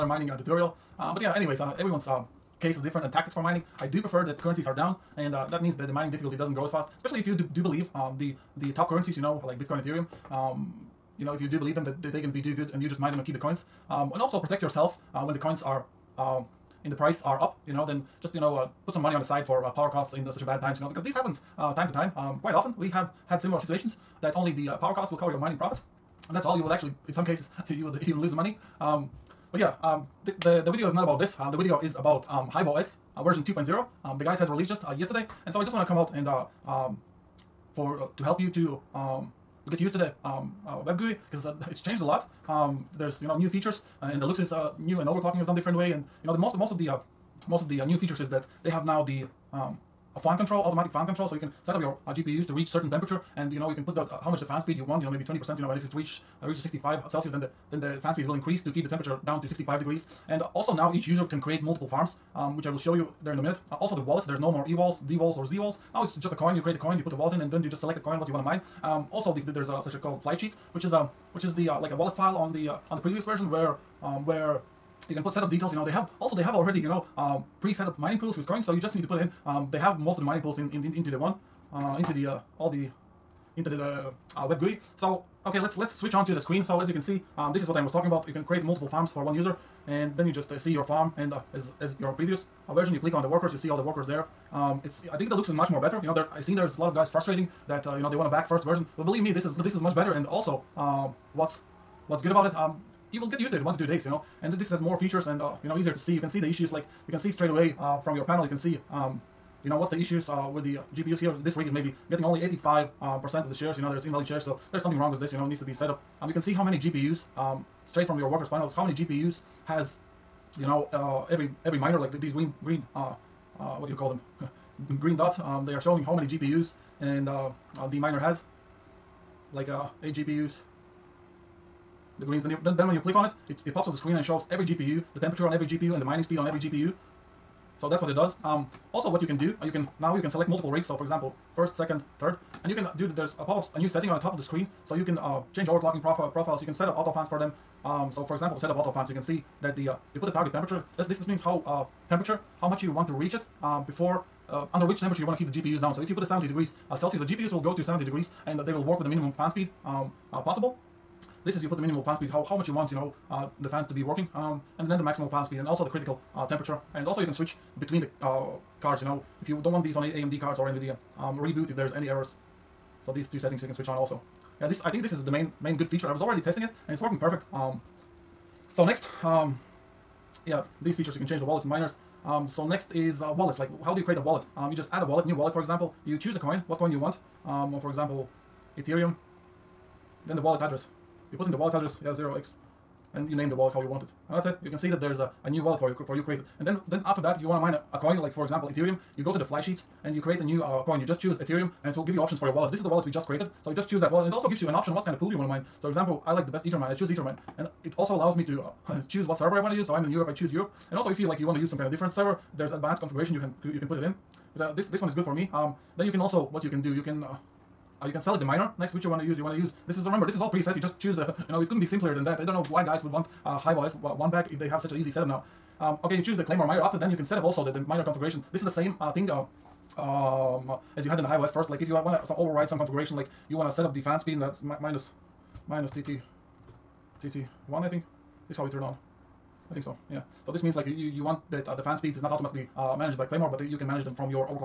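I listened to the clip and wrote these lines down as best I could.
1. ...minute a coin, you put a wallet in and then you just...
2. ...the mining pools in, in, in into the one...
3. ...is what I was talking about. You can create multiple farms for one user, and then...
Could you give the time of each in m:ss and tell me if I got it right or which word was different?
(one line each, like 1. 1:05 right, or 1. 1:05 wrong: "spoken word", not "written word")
1. 1:06 wrong: "create", not "minute"
2. 1:20 right
3. 1:27 right.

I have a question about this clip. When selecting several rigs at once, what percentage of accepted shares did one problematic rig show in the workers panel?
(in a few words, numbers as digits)
85.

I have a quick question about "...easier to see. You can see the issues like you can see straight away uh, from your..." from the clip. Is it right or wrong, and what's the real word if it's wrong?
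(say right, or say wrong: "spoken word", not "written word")
right.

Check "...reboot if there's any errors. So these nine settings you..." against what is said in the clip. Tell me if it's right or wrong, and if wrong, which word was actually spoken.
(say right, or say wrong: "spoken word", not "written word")
wrong: "two", not "nine".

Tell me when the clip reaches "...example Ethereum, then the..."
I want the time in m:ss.
3:07.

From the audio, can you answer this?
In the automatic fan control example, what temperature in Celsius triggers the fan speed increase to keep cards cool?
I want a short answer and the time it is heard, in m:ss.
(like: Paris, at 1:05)
65, at 0:56.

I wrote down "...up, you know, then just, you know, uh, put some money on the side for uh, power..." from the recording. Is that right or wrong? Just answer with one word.
right.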